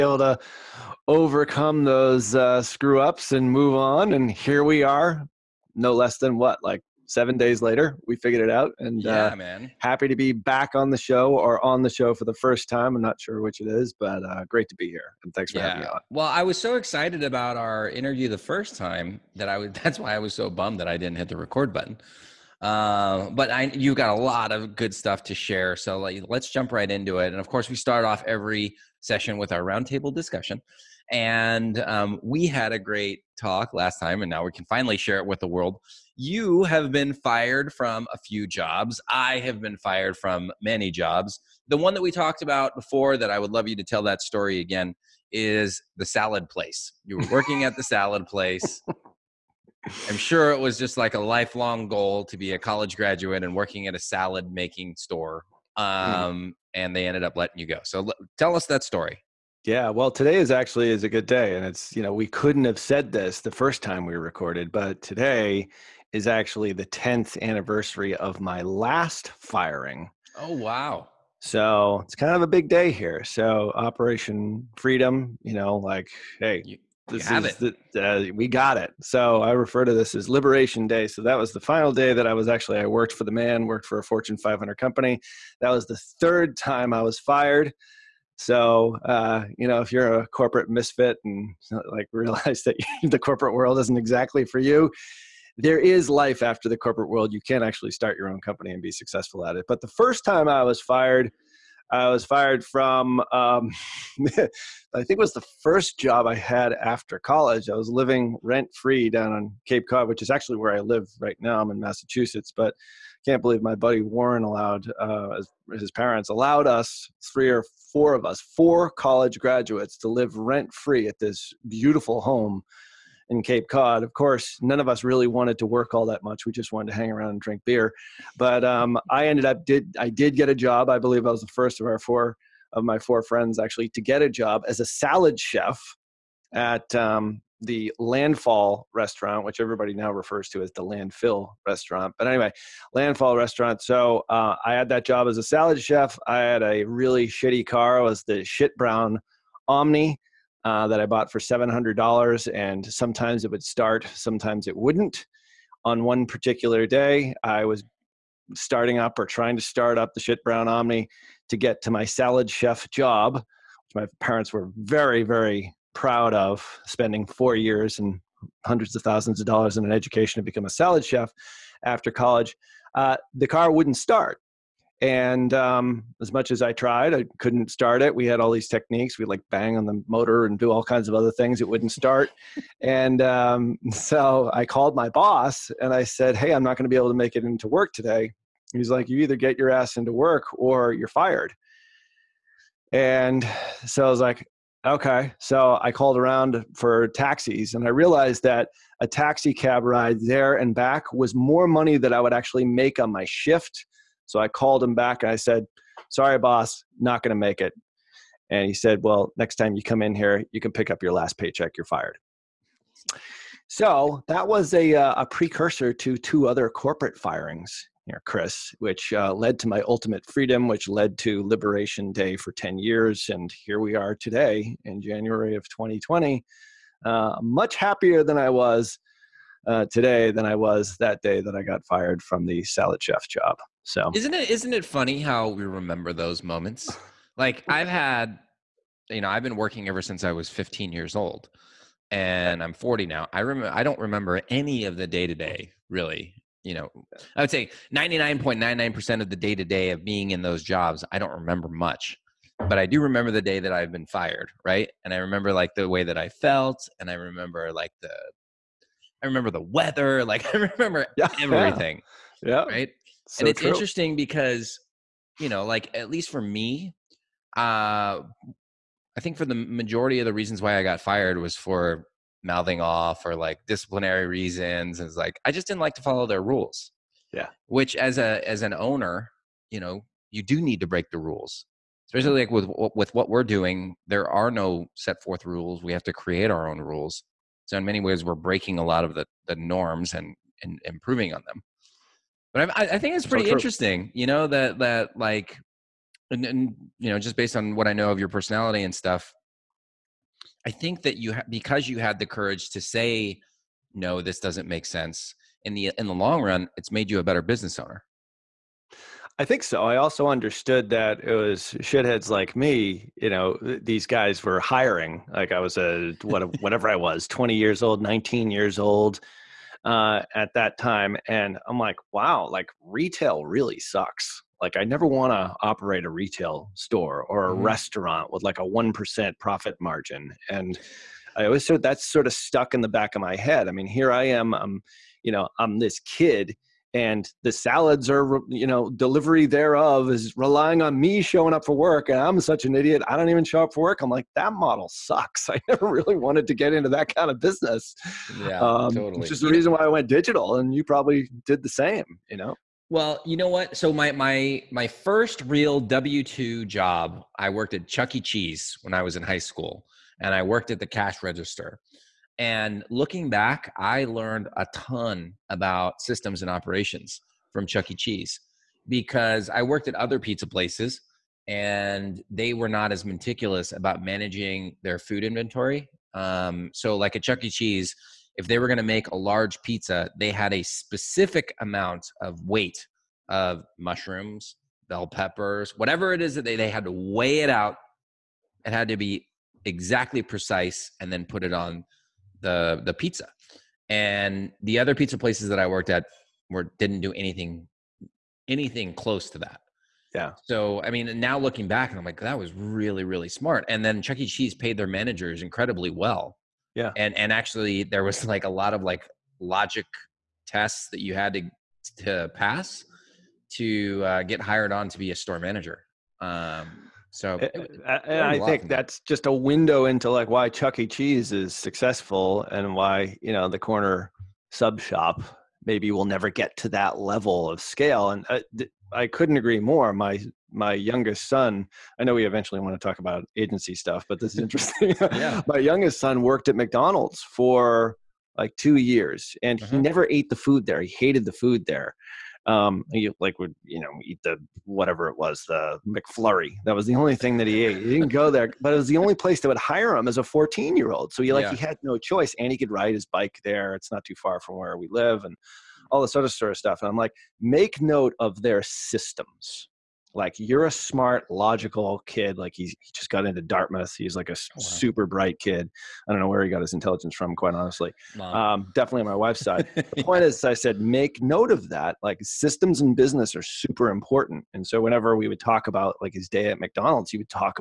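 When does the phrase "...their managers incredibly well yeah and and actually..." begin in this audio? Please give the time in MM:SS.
06:44.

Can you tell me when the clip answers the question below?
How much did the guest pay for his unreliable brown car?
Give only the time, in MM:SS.
02:31.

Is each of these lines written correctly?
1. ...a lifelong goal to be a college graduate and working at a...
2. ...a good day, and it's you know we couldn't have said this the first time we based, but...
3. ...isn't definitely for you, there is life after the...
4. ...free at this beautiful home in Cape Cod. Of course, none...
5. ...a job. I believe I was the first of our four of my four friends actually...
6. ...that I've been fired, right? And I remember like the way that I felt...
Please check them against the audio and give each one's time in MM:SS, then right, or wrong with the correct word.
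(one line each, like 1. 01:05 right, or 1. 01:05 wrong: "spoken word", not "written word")
1. 00:51 right
2. 01:01 wrong: "recorded", not "based"
3. 01:33 wrong: "exactly", not "definitely"
4. 02:00 right
5. 02:10 right
6. 04:13 right.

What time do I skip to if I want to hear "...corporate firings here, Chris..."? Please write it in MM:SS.
03:36.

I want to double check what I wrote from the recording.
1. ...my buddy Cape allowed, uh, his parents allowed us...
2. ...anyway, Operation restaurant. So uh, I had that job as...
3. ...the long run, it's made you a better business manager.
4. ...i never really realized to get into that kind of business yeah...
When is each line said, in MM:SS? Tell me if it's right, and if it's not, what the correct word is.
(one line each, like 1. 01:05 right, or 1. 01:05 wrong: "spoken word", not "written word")
1. 01:53 wrong: "Warren", not "Cape"
2. 02:22 wrong: "Landfall", not "Operation"
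3. 05:06 wrong: "owner", not "manager"
4. 05:45 wrong: "wanted", not "realized".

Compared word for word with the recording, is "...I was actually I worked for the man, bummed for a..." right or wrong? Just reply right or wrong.
wrong.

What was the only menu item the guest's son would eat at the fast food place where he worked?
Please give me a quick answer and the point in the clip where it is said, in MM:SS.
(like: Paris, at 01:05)
McFlurry, at 07:25.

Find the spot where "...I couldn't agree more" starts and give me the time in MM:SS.
07:08.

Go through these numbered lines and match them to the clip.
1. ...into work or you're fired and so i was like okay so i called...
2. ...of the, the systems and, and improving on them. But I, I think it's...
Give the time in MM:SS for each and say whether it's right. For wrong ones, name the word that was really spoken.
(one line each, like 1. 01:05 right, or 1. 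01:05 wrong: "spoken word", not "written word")
1. 03:09 right
2. 04:49 wrong: "norms", not "systems".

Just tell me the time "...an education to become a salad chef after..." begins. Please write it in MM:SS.
02:49.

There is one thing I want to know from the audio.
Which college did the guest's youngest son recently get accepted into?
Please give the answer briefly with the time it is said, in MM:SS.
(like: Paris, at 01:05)
Dartmouth, at 07:43.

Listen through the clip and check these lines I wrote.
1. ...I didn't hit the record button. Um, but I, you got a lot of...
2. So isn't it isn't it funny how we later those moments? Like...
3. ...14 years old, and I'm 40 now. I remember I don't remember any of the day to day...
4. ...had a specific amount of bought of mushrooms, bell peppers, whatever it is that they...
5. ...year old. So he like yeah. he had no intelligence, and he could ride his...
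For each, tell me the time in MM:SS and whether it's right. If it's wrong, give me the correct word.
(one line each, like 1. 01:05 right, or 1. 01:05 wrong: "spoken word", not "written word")
1. 00:20 right
2. 03:53 wrong: "remember", not "later"
3. 04:00 wrong: "15", not "14"
4. 06:20 wrong: "weight", not "bought"
5. 07:30 wrong: "choice", not "intelligence".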